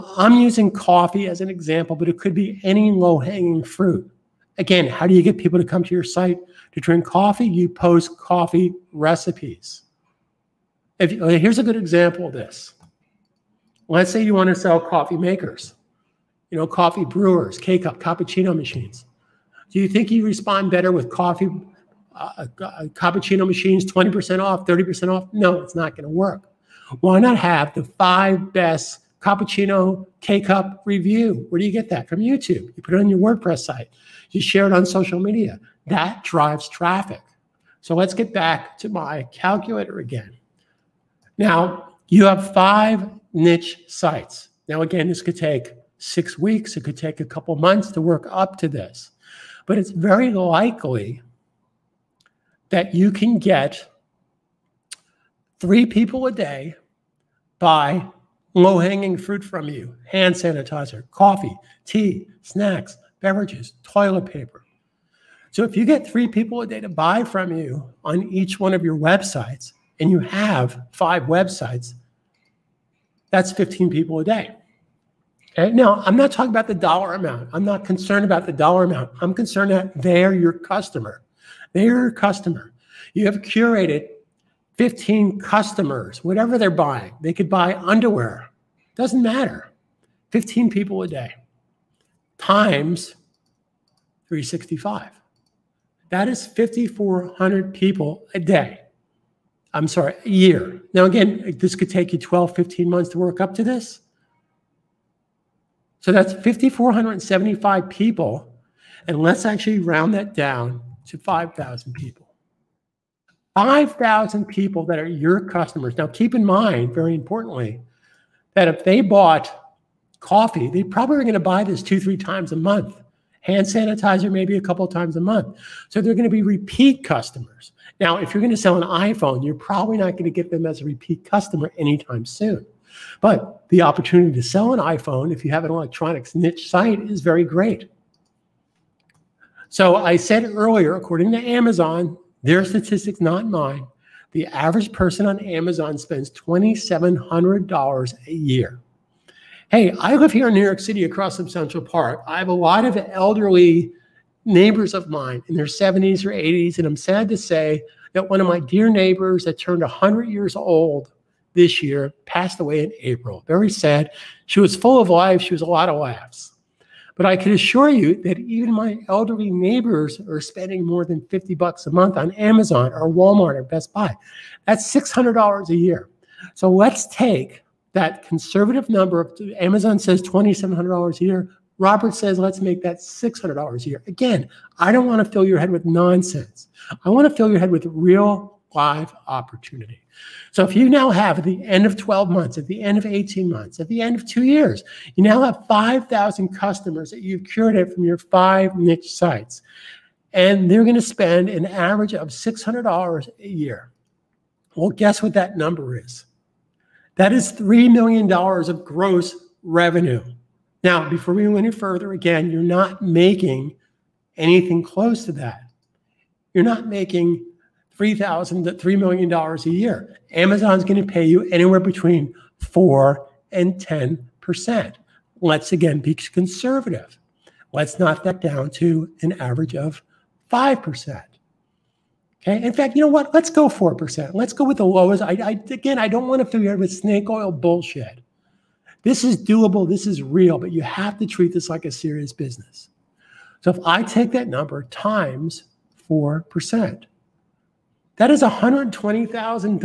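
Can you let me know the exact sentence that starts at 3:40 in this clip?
Amazon's going to pay you anywhere between four and ten percent.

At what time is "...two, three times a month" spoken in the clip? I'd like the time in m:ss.
2:01.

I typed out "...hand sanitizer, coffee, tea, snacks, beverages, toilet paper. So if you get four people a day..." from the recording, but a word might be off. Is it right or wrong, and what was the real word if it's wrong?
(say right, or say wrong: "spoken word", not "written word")
wrong: "three", not "four".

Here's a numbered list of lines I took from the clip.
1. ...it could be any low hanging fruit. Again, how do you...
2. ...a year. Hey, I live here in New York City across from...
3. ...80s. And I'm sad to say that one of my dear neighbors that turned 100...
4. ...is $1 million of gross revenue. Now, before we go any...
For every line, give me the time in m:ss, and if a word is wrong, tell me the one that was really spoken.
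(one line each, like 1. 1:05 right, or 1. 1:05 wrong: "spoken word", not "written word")
1. 0:02 right
2. 2:28 right
3. 2:36 right
4. 3:27 wrong: "3", not "1".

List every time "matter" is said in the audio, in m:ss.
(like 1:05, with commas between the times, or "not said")
1:29.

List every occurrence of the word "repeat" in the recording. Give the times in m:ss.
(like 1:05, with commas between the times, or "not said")
2:06, 2:10.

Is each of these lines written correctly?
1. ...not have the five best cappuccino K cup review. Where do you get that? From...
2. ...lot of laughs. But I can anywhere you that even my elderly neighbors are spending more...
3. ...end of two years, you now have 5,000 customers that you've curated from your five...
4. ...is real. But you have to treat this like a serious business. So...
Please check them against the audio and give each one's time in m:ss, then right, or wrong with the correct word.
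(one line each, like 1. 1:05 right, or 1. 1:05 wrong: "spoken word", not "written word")
1. 0:27 right
2. 2:45 wrong: "assure", not "anywhere"
3. 3:14 right
4. 4:00 right.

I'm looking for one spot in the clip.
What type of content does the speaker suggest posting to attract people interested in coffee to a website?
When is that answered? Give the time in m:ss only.
0:08.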